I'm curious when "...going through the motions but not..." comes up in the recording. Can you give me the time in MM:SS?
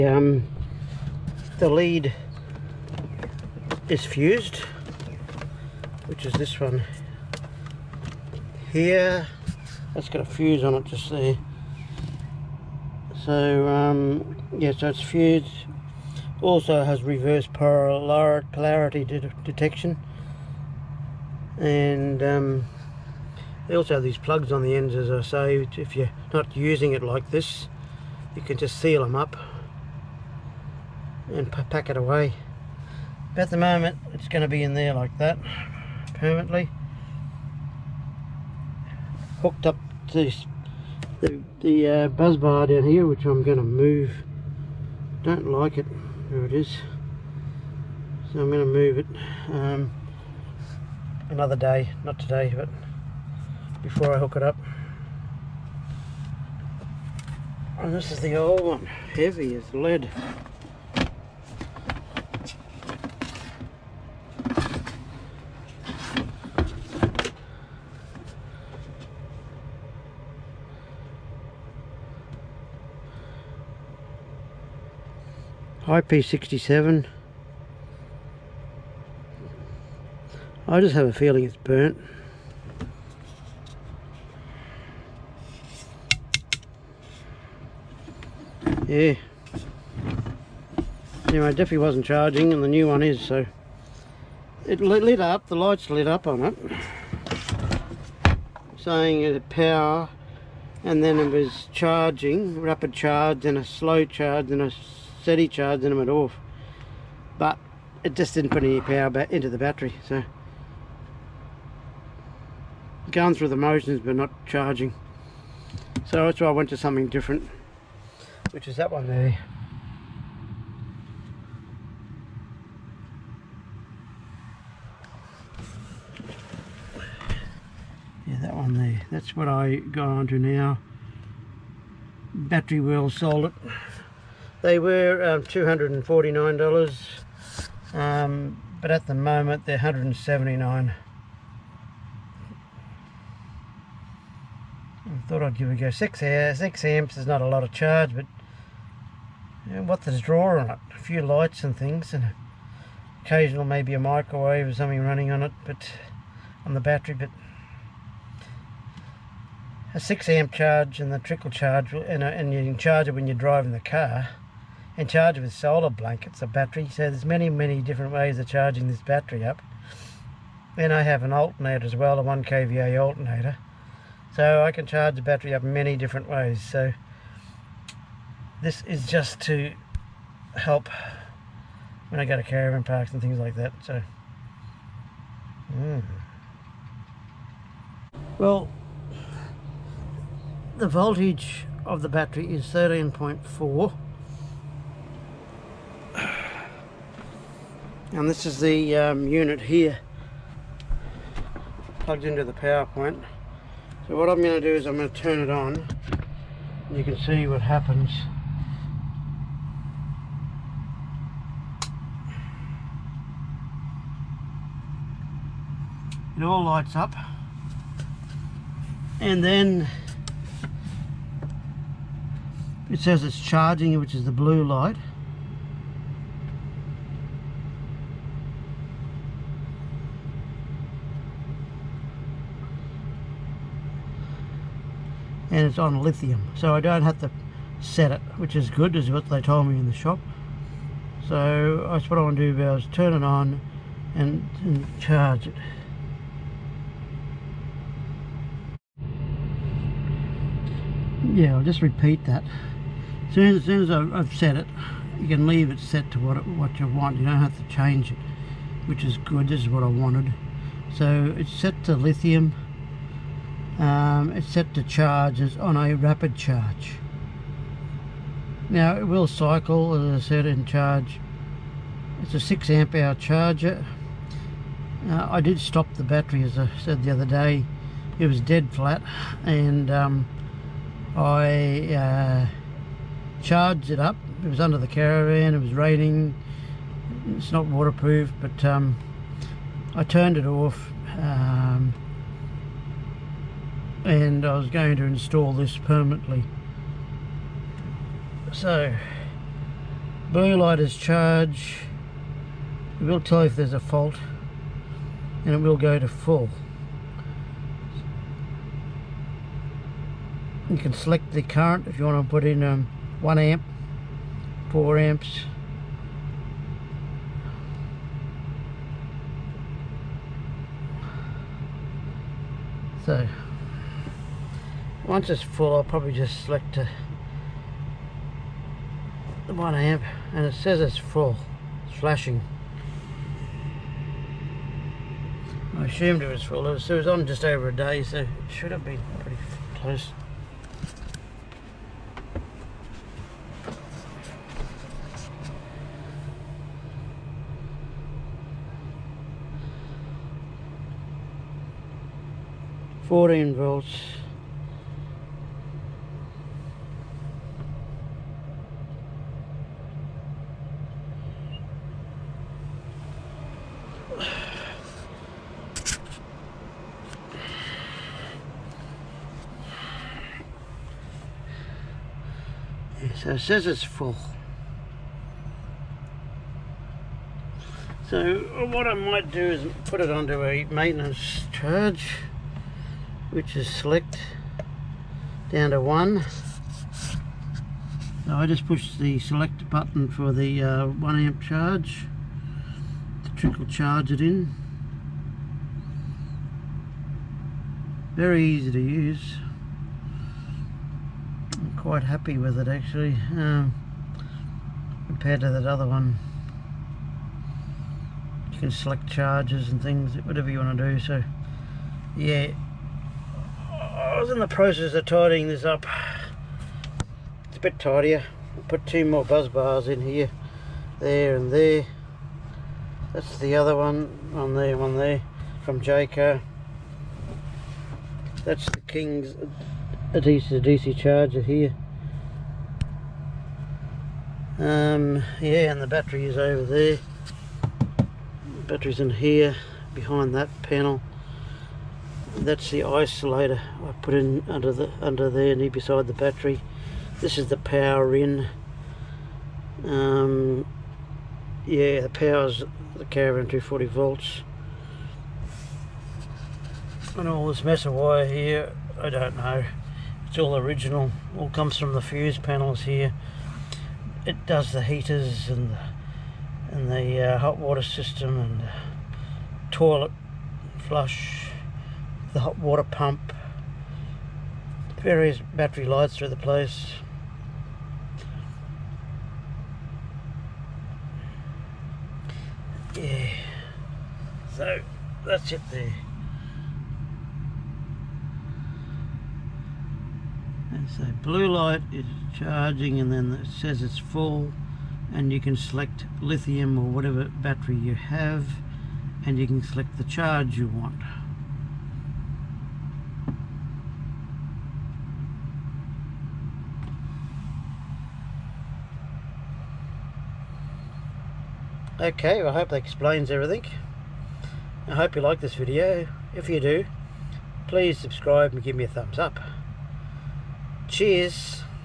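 01:53.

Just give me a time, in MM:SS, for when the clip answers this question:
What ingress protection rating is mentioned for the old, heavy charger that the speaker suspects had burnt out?
01:15.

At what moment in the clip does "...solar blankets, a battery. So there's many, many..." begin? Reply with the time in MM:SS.
02:45.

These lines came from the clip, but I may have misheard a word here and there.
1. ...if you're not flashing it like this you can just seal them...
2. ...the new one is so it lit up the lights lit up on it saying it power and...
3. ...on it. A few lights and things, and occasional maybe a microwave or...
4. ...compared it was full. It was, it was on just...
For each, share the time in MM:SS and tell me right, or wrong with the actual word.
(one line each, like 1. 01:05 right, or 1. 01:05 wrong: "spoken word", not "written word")
1. 00:25 wrong: "using", not "flashing"
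2. 01:32 right
3. 02:30 right
4. 05:35 wrong: "assumed", not "compared".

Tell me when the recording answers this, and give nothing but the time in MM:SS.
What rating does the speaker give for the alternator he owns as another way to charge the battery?
02:52.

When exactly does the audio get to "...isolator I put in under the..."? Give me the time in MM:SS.
07:22.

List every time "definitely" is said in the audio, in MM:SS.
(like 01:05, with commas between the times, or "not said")
01:31.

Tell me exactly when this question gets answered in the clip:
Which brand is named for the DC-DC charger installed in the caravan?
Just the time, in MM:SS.
07:08.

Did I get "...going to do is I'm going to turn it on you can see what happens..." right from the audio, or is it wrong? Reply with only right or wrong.
right.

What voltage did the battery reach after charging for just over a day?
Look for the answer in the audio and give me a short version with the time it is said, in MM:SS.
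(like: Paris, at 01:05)
14 volts, at 05:53.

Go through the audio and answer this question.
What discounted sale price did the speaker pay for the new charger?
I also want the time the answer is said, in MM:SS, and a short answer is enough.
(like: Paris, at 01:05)
$179, at 02:19.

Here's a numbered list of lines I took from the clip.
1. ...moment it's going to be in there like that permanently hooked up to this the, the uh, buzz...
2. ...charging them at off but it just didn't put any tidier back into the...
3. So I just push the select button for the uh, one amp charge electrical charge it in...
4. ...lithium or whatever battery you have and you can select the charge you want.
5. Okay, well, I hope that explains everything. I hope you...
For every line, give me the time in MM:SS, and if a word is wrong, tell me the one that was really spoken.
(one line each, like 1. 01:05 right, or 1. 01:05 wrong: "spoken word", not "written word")
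1. 00:33 right
2. 01:45 wrong: "power", not "tidier"
3. 06:28 right
4. 08:16 right
5. 08:31 right.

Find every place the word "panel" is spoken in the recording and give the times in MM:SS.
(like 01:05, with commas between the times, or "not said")
07:20, 07:42.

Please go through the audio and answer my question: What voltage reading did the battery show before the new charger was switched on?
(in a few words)
13.4.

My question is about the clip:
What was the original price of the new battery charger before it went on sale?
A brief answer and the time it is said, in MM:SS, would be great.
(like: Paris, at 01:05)
$249, at 02:15.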